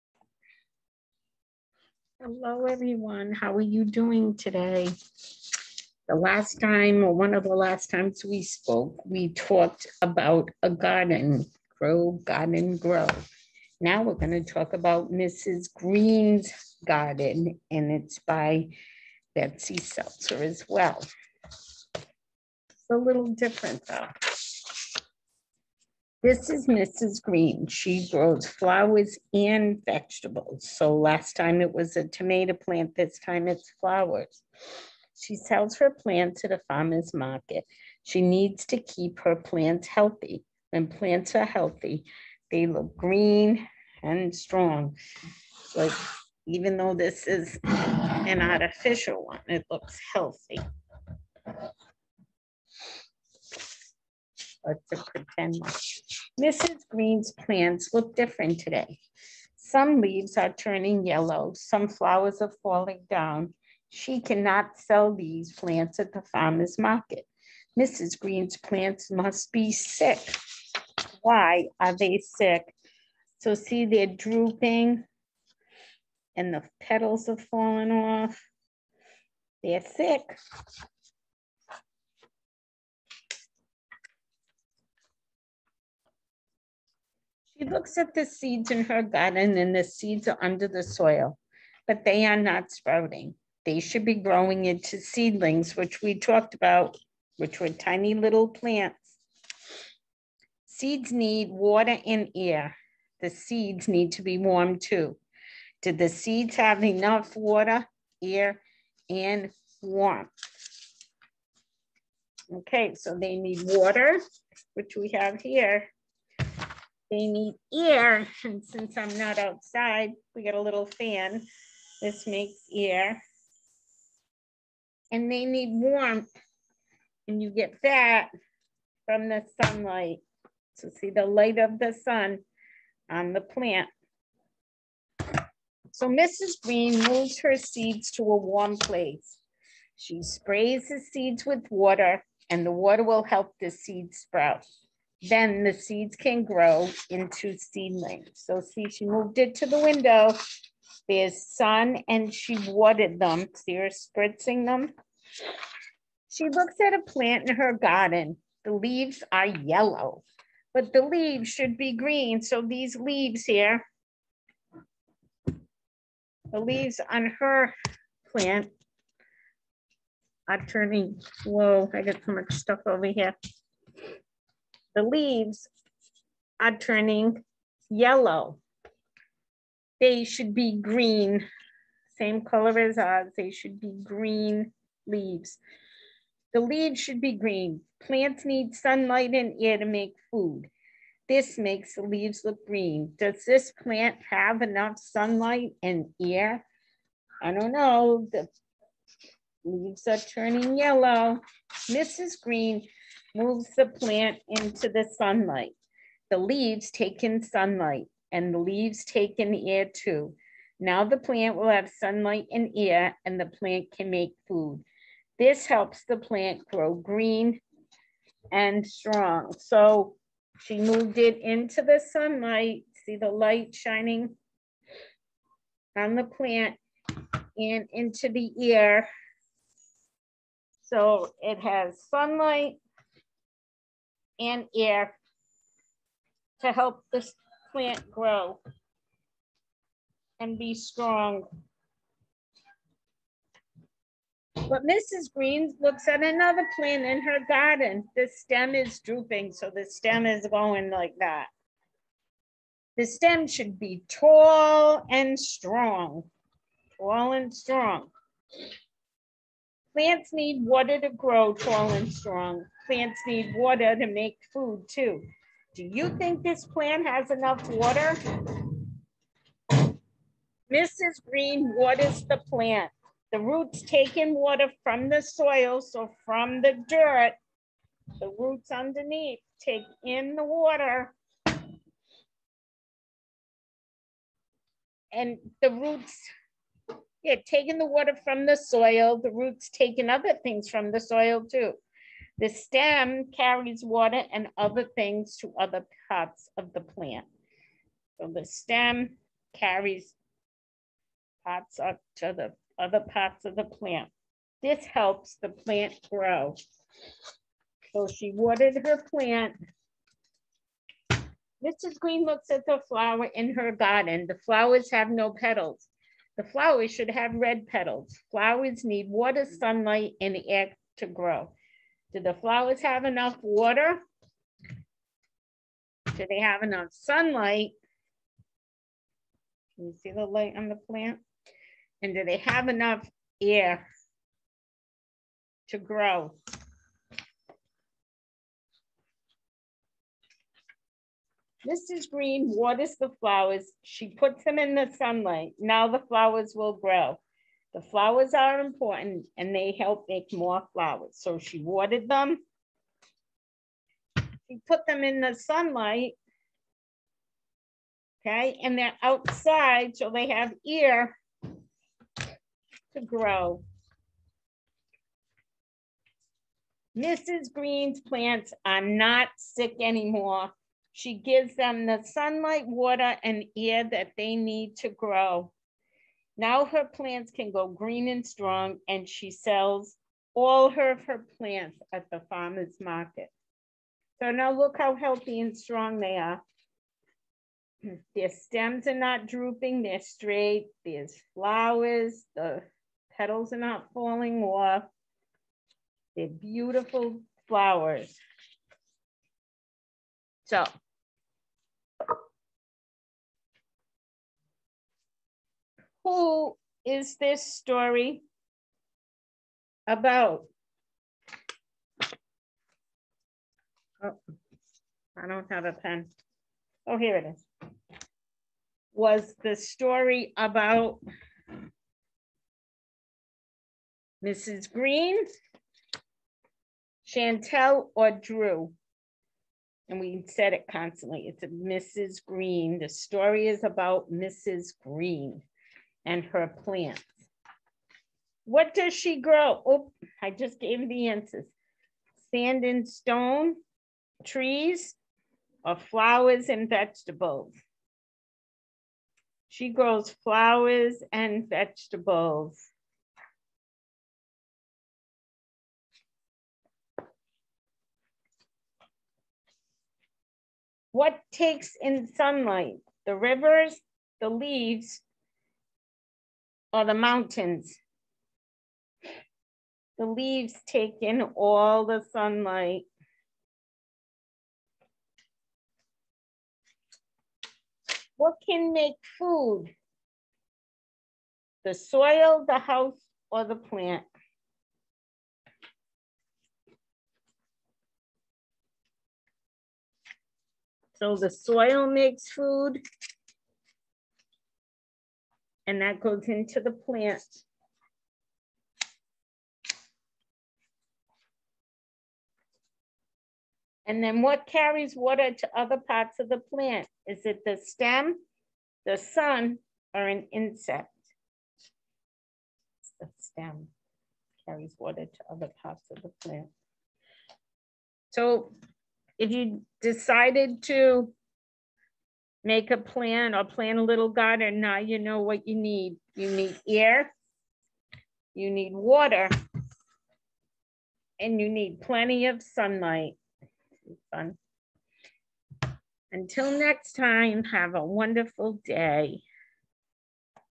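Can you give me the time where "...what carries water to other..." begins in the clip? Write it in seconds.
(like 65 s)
504 s.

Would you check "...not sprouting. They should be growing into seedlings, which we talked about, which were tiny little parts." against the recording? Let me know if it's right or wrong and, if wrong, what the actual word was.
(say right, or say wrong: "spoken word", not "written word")
wrong: "plants", not "parts".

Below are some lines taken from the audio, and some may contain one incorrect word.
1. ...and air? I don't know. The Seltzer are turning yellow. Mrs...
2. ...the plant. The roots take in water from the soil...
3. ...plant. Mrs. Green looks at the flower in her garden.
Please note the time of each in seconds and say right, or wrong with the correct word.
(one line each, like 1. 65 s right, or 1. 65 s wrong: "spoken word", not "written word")
1. 195 s wrong: "Leaves", not "Seltzer"
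2. 272 s right
3. 308 s right.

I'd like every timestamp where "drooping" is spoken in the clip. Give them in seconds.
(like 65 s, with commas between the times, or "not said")
74 s, 248 s, 389 s.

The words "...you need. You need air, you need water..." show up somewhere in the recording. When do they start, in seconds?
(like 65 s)
525 s.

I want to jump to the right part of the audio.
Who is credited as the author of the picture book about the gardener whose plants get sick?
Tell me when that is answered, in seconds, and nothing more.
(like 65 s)
19 s.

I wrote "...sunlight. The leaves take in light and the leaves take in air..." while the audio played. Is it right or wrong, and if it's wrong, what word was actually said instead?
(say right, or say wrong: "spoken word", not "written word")
wrong: "sunlight", not "light".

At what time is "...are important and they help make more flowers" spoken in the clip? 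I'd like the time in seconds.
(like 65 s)
348 s.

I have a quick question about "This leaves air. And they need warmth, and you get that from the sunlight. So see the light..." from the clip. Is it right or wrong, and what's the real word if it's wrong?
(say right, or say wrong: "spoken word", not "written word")
wrong: "makes", not "leaves".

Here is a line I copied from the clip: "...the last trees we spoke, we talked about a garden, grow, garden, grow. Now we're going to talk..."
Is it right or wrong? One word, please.
wrong.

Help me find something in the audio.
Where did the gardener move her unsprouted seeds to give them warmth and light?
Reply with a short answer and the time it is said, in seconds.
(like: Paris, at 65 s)
the window, at 149 s.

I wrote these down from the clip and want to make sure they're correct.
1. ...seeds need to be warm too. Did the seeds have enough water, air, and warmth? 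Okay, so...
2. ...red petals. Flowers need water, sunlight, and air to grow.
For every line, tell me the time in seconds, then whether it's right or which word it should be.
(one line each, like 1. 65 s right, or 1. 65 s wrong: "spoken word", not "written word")
1. 103 s right
2. 317 s right.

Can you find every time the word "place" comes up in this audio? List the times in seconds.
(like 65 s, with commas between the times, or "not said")
138 s.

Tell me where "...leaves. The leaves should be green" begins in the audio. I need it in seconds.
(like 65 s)
185 s.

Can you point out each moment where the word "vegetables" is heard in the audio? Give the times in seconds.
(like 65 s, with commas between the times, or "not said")
29 s, 446 s, 451 s.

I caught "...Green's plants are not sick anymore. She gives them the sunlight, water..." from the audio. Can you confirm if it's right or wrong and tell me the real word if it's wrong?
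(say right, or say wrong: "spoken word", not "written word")
right.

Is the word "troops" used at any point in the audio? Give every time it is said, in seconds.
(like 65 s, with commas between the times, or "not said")
not said.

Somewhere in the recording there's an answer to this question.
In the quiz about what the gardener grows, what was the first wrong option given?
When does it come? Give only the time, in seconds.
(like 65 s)
442 s.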